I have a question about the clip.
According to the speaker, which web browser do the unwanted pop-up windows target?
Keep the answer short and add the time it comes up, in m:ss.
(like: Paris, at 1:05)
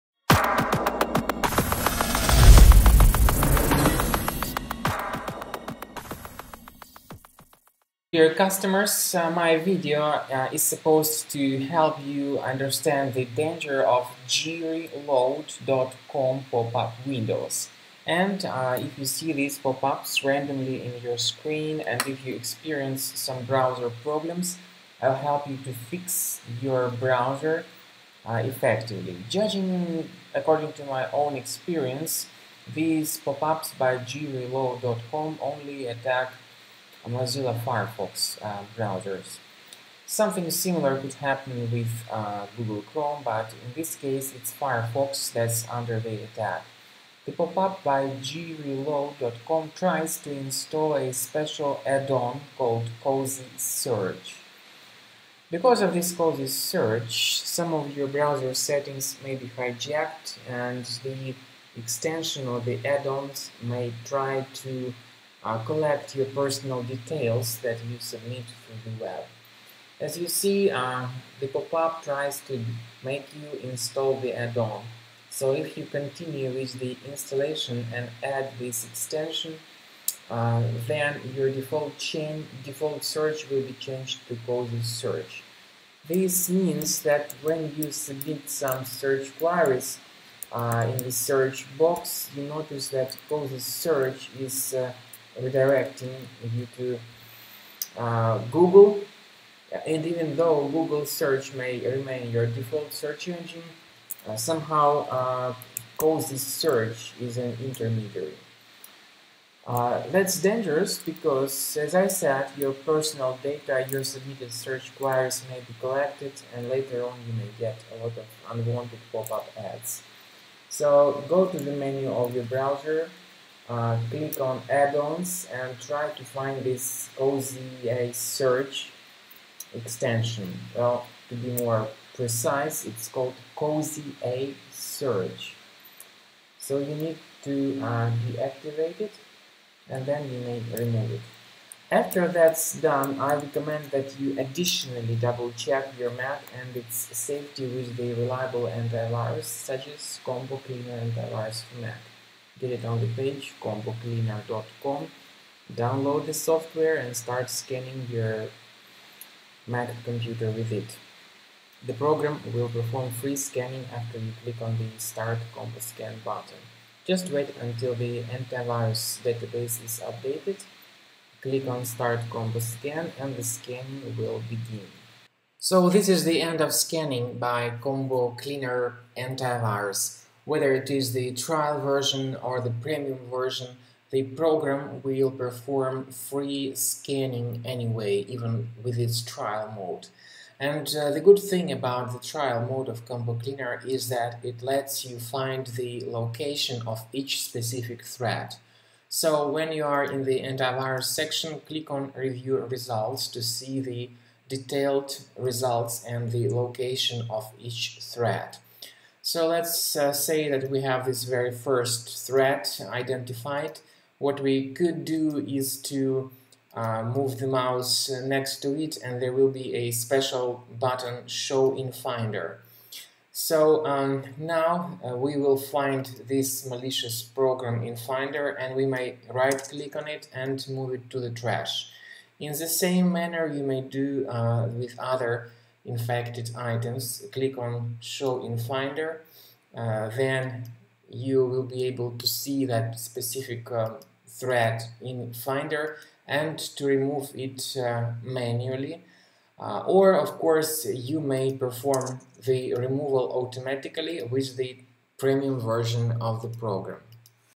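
Mozilla Firefox, at 0:37.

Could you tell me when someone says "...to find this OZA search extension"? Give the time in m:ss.
2:06.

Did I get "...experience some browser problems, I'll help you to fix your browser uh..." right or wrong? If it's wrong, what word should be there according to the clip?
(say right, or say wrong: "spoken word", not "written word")
right.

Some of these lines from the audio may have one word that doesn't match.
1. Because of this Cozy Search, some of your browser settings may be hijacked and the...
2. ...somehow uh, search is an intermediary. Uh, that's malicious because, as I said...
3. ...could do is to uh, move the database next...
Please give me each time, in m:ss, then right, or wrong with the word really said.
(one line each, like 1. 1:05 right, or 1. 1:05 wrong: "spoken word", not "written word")
1. 0:55 right
2. 1:44 wrong: "dangerous", not "malicious"
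3. 3:34 wrong: "mouse", not "database".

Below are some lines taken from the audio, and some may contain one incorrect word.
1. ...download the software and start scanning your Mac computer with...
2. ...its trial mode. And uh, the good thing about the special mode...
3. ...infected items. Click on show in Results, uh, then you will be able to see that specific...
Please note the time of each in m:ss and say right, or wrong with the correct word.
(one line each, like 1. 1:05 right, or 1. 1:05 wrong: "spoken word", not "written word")
1. 2:35 right
2. 3:08 wrong: "trial", not "special"
3. 3:55 wrong: "Finder", not "Results".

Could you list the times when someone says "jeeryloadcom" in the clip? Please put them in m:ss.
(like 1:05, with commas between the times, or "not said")
0:14, 0:33, 0:48.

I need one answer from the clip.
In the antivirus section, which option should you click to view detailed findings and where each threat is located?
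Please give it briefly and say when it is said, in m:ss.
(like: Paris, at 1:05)
Review Results, at 3:22.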